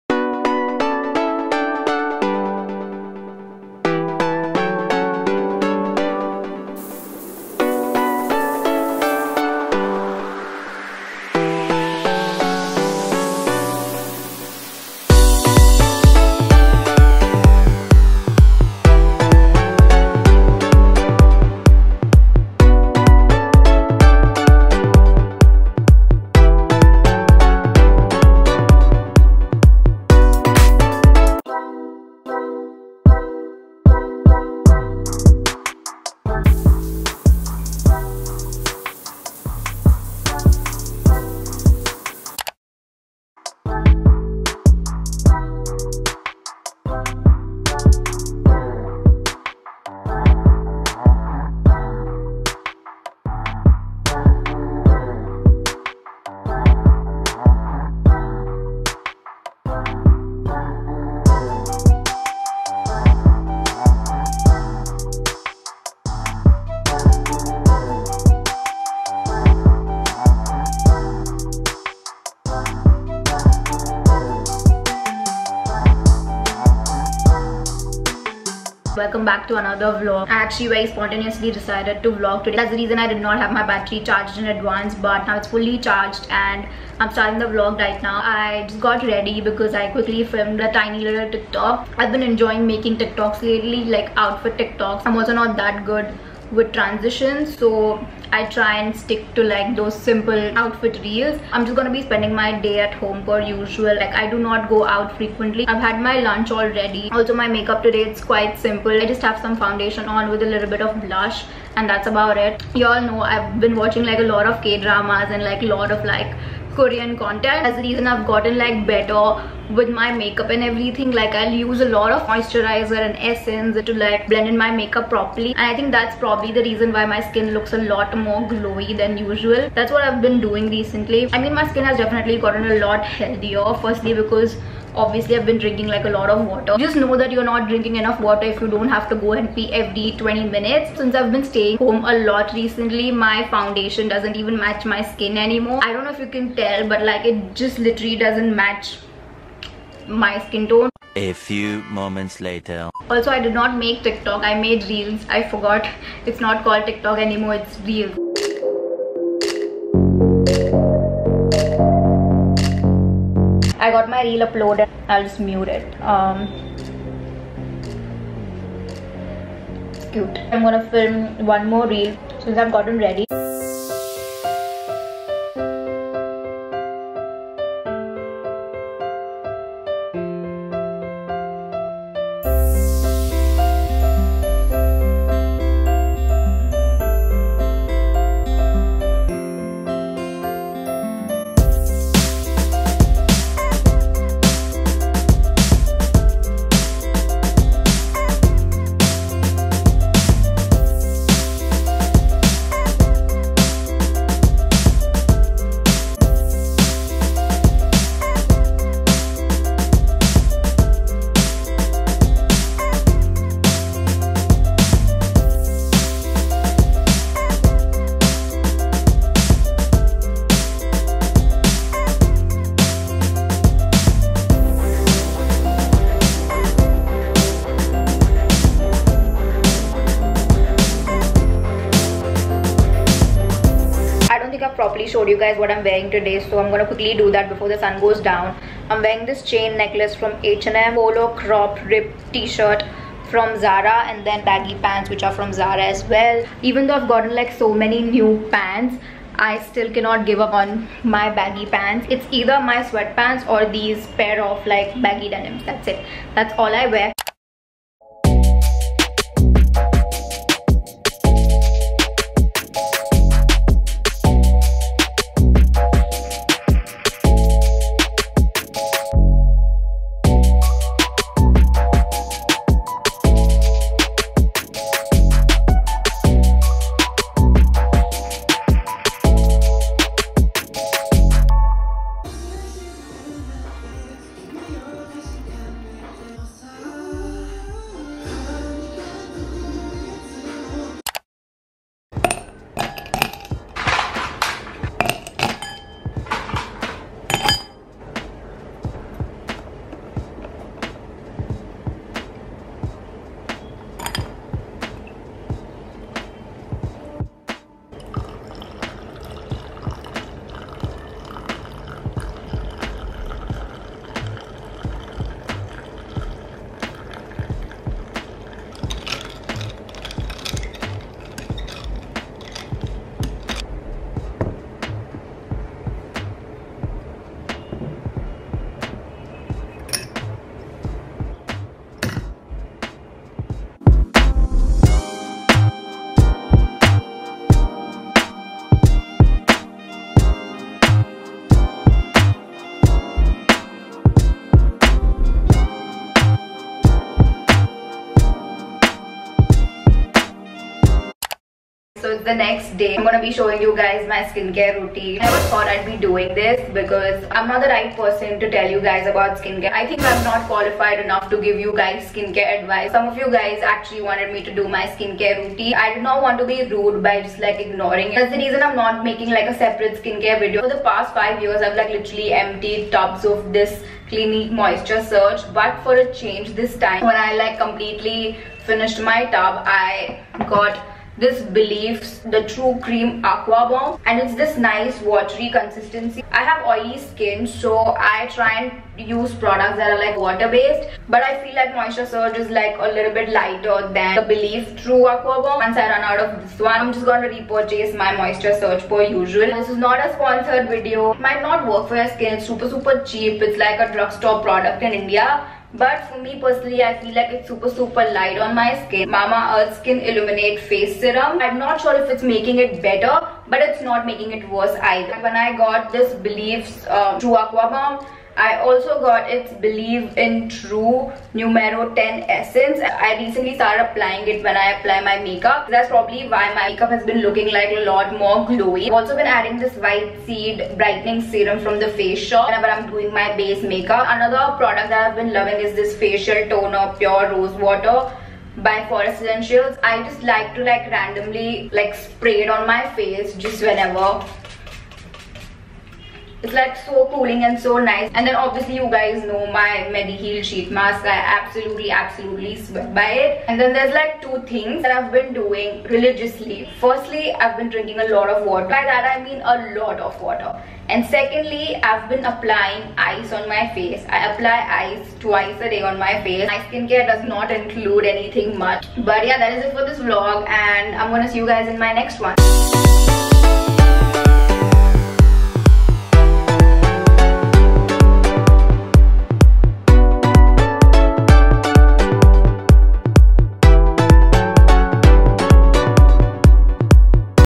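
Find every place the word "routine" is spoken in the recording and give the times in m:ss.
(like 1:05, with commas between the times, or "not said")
5:54, 6:05.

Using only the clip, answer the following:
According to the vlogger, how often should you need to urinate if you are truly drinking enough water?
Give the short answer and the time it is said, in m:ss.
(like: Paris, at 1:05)
every 20 minutes, at 2:19.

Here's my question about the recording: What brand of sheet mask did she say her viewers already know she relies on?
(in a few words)
Mediheal.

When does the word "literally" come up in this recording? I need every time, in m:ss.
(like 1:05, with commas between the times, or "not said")
2:27, 6:11.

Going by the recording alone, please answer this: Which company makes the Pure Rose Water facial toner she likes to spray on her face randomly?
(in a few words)
Forest Essentials.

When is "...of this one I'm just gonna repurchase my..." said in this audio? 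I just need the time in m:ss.
6:36.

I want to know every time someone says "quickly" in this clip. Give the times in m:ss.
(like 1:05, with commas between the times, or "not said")
1:29, 3:56.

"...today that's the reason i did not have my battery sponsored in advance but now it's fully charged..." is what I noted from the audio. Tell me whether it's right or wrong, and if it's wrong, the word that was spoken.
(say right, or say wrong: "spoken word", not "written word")
wrong: "charged", not "sponsored".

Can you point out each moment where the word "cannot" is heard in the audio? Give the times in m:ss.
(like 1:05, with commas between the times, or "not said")
4:09.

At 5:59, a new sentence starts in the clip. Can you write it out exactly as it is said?
I think I'm not qualified enough to give you guys skincare advice.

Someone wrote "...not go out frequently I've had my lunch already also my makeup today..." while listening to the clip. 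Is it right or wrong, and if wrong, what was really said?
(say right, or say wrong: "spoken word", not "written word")
right.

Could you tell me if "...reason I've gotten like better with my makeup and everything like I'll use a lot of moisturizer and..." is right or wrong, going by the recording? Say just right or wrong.
right.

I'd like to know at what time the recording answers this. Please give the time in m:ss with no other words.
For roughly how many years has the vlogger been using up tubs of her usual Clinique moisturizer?
6:11.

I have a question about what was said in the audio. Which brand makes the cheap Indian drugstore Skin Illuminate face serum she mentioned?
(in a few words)
Mamaearth.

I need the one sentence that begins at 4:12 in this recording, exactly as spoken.
It's either my sweatpants or these pair of like baggy denims.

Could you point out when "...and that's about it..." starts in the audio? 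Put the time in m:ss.
1:51.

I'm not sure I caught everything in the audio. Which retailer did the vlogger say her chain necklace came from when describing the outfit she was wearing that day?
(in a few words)
H&M.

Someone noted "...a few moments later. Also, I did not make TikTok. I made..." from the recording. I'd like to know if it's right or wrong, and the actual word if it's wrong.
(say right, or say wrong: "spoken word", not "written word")
right.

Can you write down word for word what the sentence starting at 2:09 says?
That's what I've been doing recently.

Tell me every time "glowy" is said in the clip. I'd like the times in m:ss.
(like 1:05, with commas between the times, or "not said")
2:08, 7:08.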